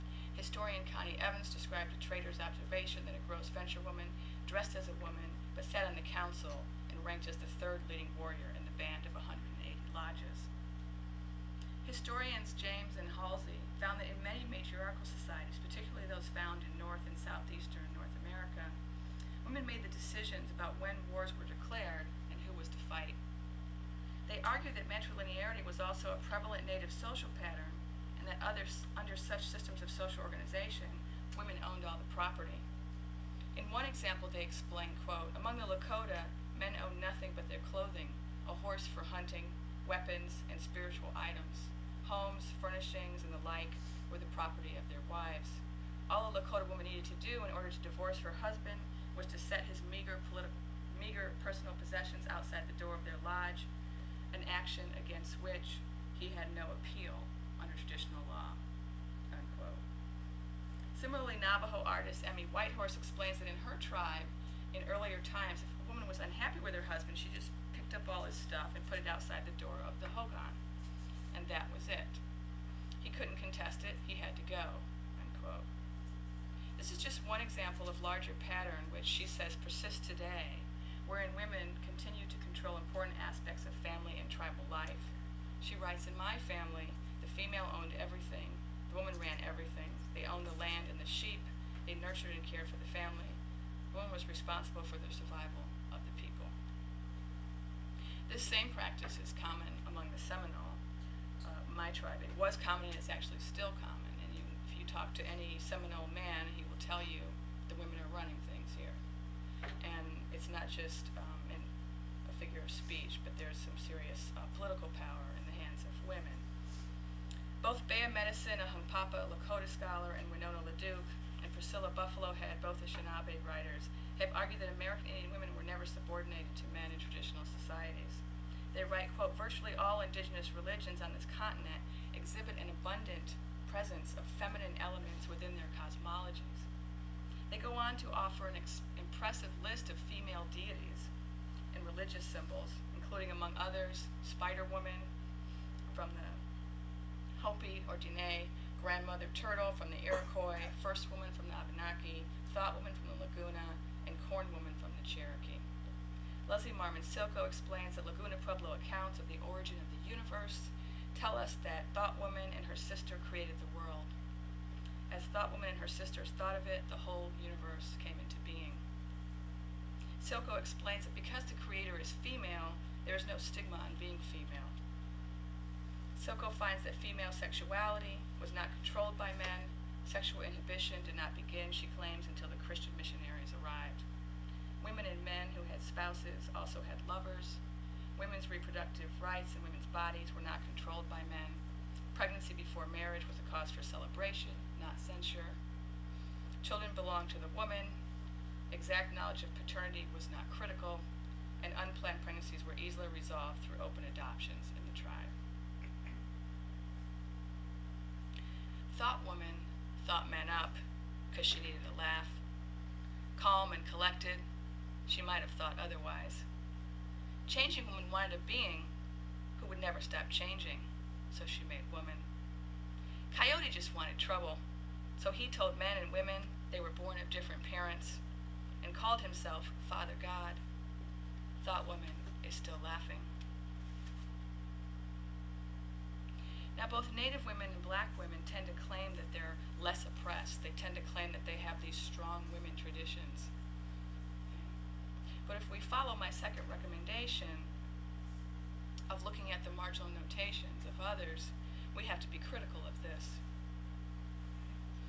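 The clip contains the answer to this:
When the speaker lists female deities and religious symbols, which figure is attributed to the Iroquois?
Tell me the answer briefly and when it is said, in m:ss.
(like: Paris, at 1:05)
Grandmother Turtle, at 2:28.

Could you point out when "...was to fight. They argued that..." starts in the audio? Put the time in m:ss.
0:22.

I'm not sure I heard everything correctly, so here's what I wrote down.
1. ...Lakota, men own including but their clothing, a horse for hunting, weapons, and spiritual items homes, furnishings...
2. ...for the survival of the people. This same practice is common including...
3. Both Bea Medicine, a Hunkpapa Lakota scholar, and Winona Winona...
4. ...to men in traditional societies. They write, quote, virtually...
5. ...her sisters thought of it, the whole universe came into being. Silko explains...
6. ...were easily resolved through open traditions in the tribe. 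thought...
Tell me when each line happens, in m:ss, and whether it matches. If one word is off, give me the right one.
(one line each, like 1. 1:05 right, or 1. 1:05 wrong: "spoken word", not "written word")
1. 0:35 wrong: "nothing", not "including"
2. 1:34 wrong: "among", not "including"
3. 1:57 wrong: "LaDuke", not "Winona"
4. 2:06 right
5. 2:45 right
6. 3:22 wrong: "adoptions", not "traditions".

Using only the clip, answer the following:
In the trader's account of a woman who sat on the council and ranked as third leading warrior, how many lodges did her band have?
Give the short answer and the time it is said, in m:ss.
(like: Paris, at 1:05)
180, at 0:09.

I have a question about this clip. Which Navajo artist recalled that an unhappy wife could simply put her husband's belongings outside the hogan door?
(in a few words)
Emmi Whitehorse.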